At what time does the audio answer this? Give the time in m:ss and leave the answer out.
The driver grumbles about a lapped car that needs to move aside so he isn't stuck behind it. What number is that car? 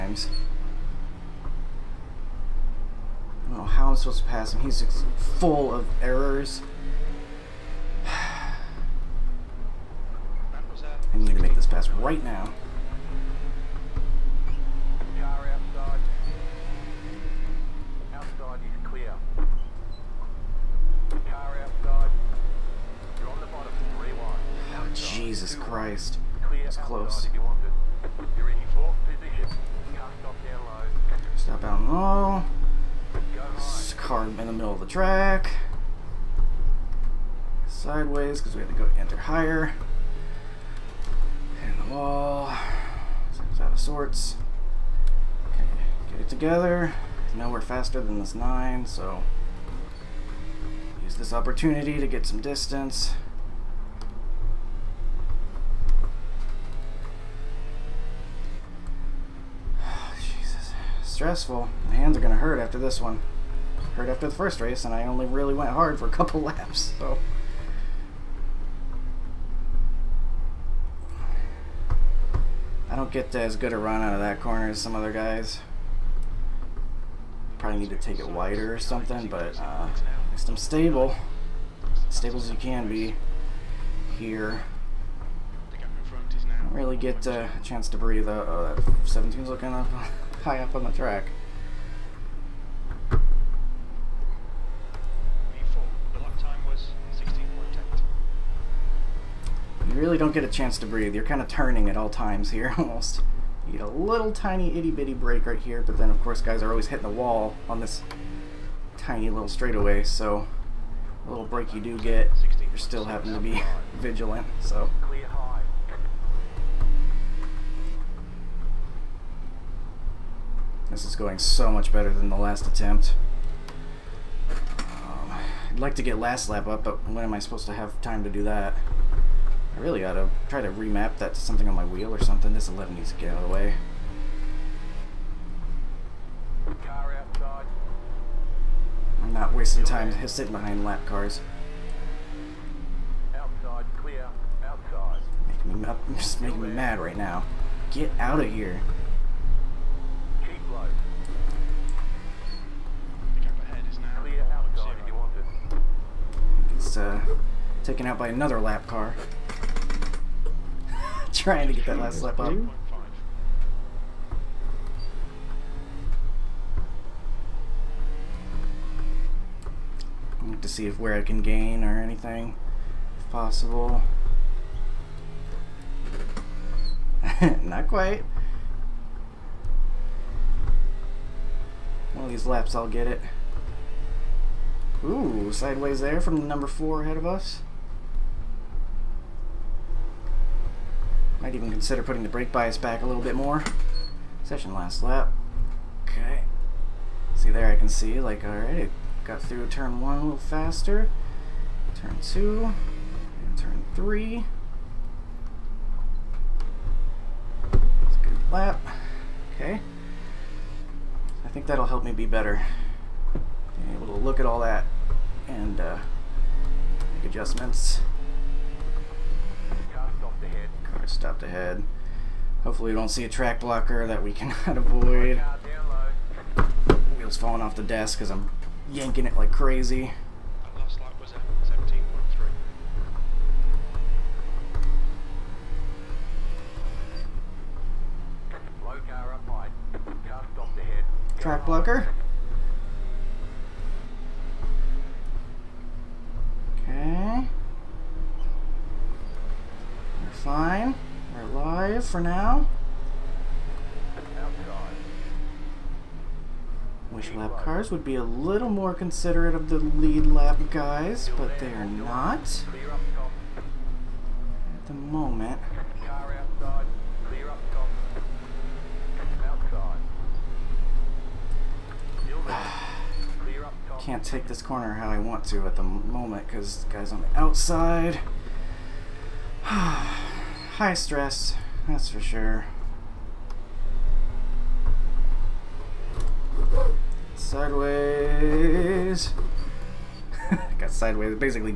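2:12.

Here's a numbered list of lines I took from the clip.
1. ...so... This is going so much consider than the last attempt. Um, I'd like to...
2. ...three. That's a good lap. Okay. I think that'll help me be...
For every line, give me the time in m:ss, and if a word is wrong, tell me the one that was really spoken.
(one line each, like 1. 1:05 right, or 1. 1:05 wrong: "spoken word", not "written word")
1. 1:54 wrong: "better", not "consider"
2. 3:23 right.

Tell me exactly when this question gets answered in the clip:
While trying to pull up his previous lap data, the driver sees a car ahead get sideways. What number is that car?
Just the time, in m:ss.
3:06.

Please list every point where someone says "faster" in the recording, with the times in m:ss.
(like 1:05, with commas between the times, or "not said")
0:47, 3:20.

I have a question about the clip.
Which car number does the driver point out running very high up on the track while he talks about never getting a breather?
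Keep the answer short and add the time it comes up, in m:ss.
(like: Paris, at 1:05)
17, at 1:29.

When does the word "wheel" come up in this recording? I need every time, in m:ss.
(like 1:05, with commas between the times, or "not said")
2:11, 3:47.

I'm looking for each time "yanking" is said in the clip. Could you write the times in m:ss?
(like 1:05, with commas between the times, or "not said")
3:48.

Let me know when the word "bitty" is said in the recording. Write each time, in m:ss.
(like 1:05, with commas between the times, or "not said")
1:44.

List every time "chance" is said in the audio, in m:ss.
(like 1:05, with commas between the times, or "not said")
1:27, 1:40.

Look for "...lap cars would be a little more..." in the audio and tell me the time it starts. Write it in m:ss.
4:17.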